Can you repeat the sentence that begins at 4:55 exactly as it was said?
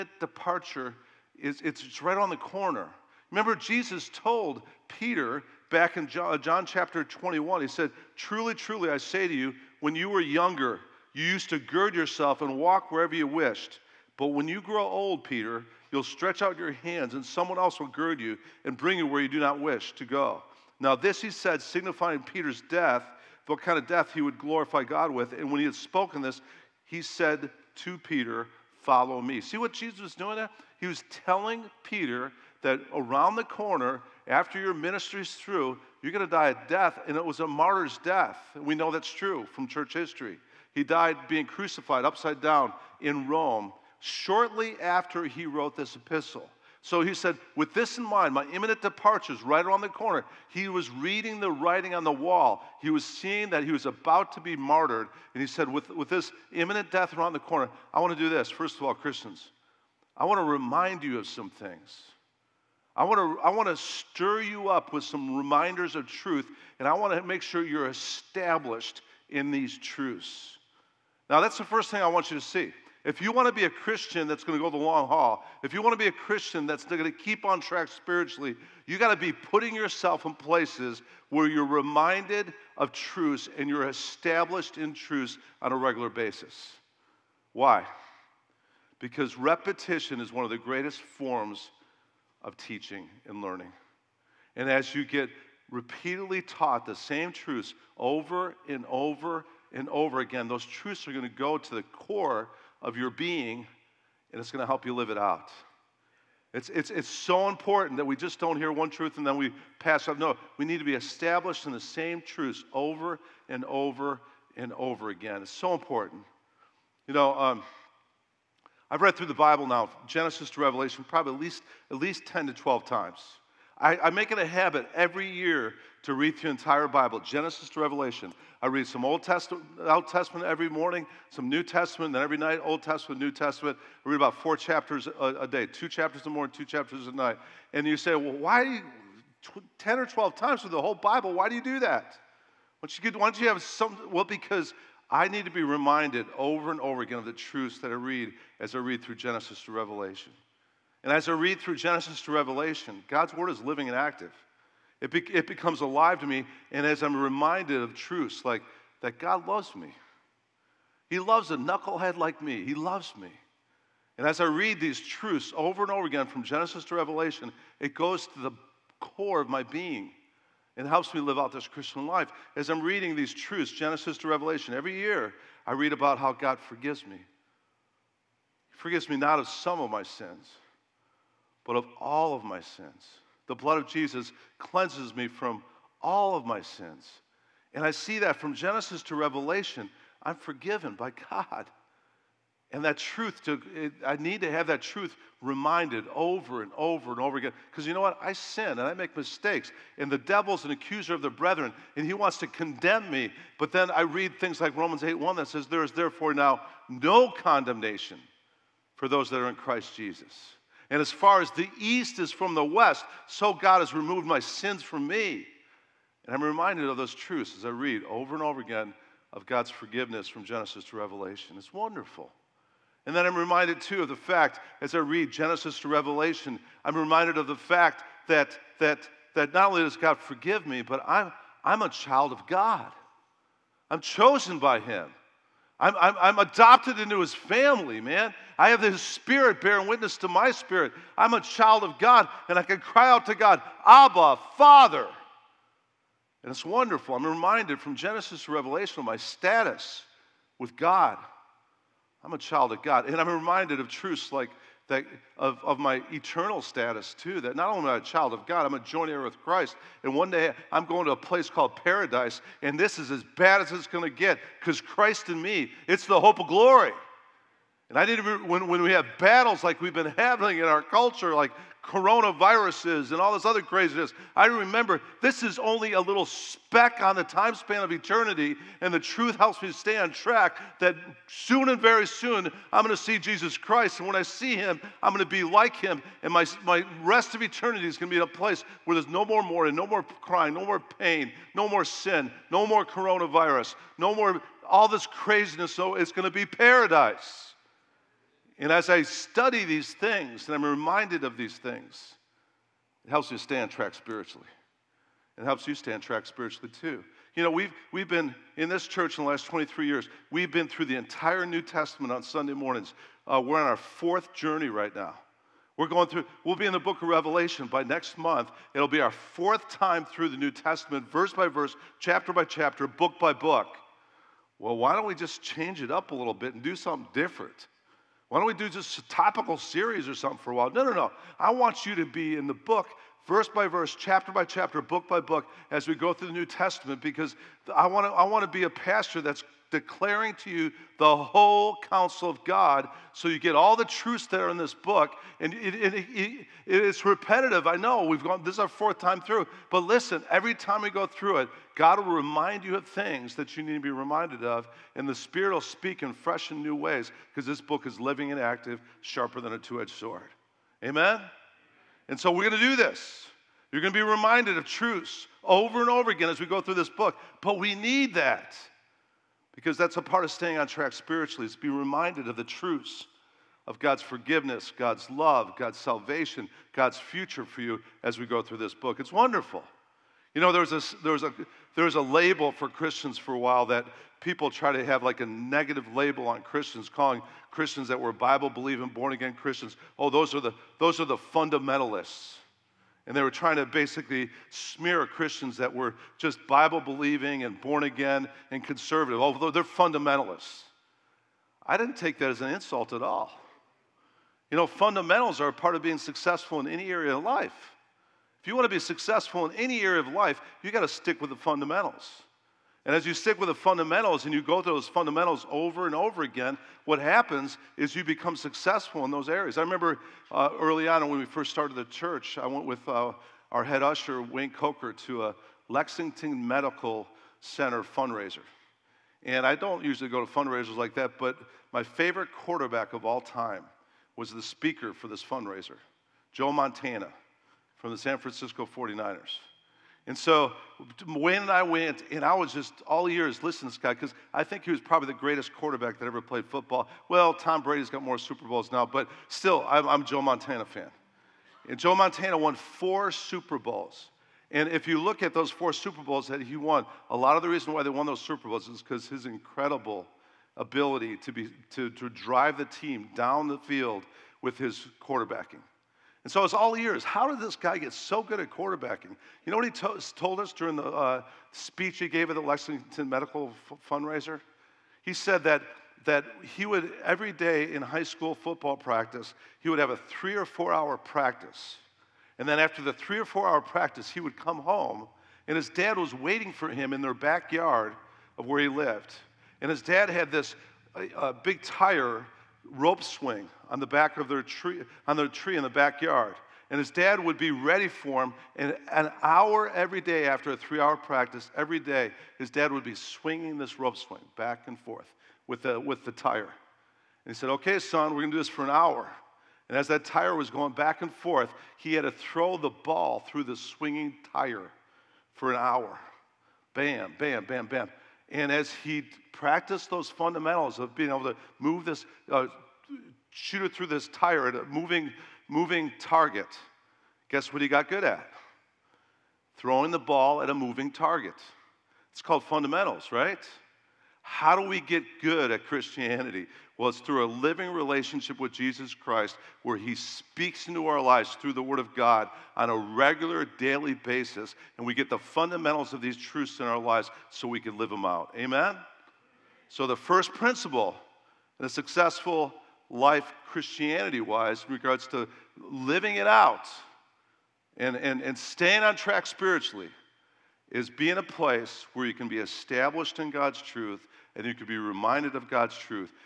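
So it's going to be paradise.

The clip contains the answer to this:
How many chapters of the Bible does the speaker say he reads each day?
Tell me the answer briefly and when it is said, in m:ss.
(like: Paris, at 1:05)
4, at 2:14.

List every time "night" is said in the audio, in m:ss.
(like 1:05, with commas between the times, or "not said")
2:12, 2:17.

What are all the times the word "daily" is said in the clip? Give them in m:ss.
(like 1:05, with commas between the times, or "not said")
9:03.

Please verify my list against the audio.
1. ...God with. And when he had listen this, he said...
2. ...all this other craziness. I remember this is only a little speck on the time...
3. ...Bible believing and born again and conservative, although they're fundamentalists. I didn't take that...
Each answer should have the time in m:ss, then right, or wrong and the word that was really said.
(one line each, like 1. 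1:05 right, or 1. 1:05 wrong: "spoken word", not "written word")
1. 0:24 wrong: "spoken", not "listen"
2. 4:33 right
3. 6:36 right.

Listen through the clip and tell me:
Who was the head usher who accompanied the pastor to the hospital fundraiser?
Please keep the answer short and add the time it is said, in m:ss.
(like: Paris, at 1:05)
Wayne Coker, at 7:04.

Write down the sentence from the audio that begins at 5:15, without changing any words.
We're going through, we'll be in the book of Revelation by next month.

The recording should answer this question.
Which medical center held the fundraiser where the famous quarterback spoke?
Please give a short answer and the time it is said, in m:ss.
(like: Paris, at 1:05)
Lexington Medical Center, at 7:05.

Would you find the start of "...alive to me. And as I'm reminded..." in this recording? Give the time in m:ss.
2:35.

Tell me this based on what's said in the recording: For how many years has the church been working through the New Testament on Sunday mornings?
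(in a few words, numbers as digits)
23.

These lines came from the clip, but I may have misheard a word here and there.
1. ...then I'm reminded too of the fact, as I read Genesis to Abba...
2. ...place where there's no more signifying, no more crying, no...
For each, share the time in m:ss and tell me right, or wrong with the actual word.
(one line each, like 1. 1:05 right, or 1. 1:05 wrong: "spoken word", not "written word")
1. 3:43 wrong: "Revelation", not "Abba"
2. 4:48 wrong: "mourning", not "signifying".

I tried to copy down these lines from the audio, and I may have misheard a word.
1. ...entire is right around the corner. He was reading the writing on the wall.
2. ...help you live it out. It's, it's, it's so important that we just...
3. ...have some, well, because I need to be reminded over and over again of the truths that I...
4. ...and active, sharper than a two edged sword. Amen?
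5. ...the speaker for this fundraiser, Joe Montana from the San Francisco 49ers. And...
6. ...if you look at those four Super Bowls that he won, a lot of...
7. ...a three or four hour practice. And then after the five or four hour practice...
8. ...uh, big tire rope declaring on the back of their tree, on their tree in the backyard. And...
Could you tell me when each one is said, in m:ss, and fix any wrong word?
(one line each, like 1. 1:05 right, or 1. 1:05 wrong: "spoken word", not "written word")
1. 0:48 wrong: "departure", not "entire"
2. 1:44 right
3. 2:23 right
4. 5:58 right
5. 7:14 right
6. 7:34 right
7. 7:59 wrong: "three", not "five"
8. 8:11 wrong: "swing", not "declaring".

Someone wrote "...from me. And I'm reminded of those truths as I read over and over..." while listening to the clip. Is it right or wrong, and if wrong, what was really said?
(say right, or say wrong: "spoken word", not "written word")
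right.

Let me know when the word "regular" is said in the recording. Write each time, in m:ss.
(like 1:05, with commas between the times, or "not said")
1:25, 9:02.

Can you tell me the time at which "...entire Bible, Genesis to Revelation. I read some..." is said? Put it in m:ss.
2:06.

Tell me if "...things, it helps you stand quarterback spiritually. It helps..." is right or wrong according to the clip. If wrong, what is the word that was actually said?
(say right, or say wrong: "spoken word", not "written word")
wrong: "track", not "quarterback".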